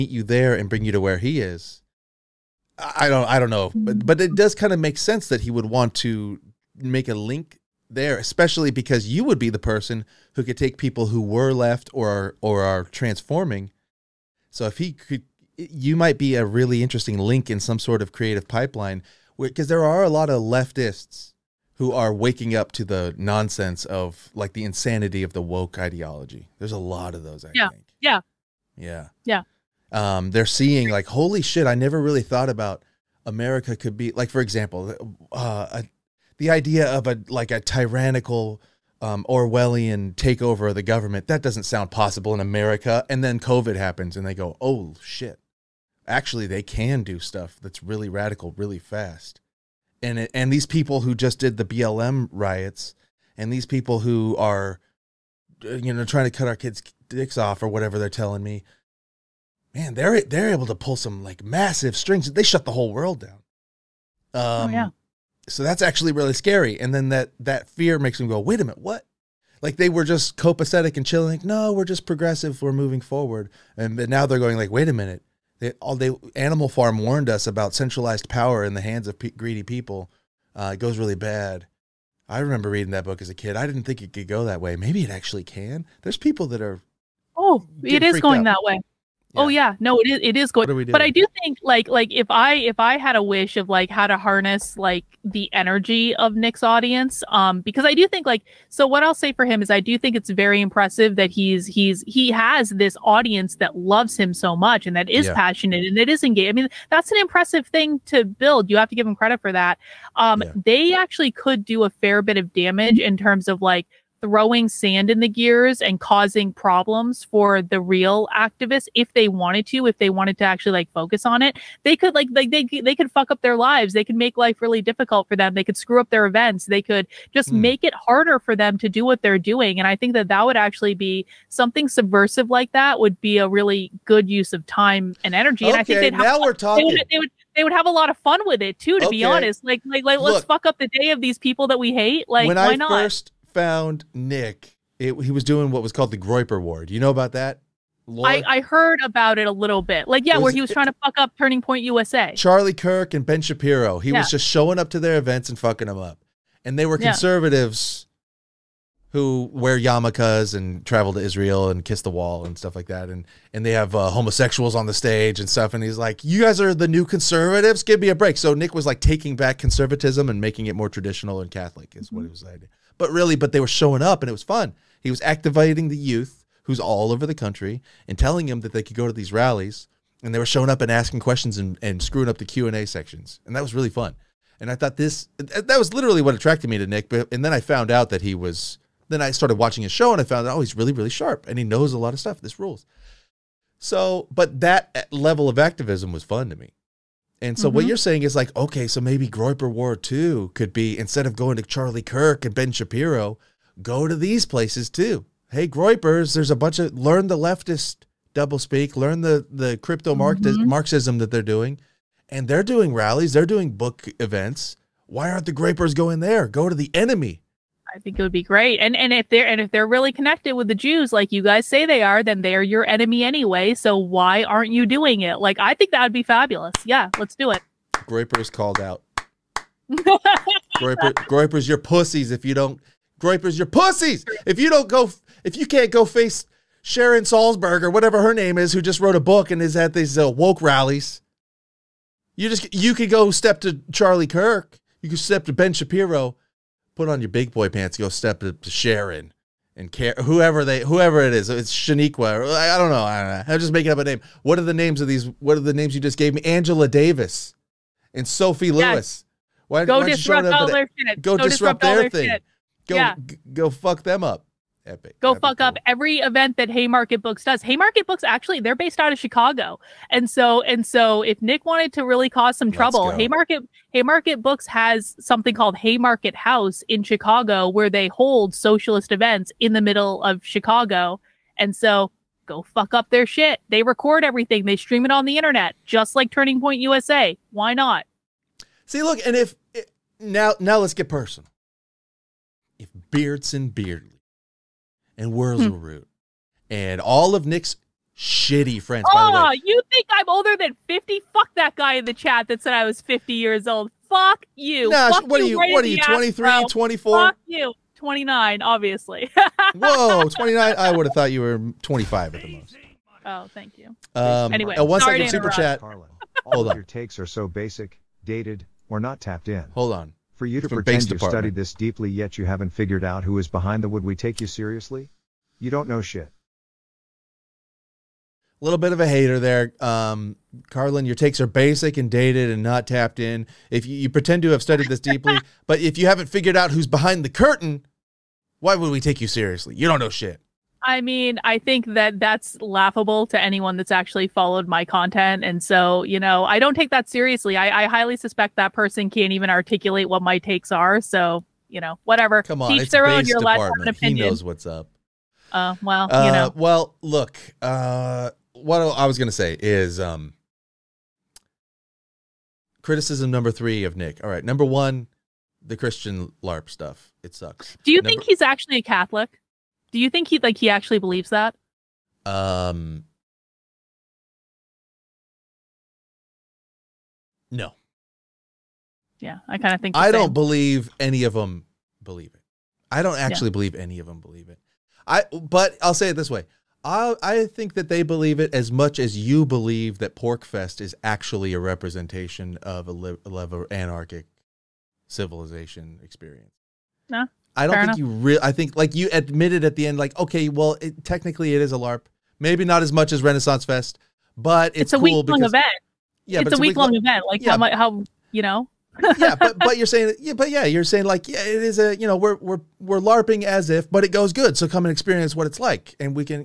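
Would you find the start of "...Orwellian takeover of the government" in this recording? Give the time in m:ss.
0:39.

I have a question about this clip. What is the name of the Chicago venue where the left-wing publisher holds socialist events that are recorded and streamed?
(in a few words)
Haymarket House.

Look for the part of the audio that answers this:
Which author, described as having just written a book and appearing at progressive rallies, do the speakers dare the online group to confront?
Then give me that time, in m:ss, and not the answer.
3:56.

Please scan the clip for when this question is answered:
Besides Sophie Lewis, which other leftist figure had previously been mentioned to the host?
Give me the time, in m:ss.
4:16.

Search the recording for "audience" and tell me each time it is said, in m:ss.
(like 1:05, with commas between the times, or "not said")
1:36, 1:43.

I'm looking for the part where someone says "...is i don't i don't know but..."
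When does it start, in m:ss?
0:01.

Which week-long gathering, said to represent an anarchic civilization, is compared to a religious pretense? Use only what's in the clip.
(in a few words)
PorcFest.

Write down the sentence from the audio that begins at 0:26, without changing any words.
There's a lot of those, I yeah.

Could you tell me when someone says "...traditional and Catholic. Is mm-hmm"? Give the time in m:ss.
2:50.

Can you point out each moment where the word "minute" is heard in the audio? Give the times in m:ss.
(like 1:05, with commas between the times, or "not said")
1:08, 1:14.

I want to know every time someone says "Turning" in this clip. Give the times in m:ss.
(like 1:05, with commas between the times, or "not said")
2:31, 4:46.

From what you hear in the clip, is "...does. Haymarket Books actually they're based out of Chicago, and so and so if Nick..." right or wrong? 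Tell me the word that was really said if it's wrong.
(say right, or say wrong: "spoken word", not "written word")
right.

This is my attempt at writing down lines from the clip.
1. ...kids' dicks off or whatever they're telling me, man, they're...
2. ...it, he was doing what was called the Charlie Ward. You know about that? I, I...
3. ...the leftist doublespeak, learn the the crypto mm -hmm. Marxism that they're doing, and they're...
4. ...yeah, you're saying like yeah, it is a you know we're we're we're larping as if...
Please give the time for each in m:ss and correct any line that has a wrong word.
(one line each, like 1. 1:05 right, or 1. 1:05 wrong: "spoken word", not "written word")
1. 0:56 right
2. 2:24 wrong: "Groyper", not "Charlie"
3. 3:27 right
4. 6:50 right.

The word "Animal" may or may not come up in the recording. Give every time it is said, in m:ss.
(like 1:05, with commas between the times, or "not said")
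1:16.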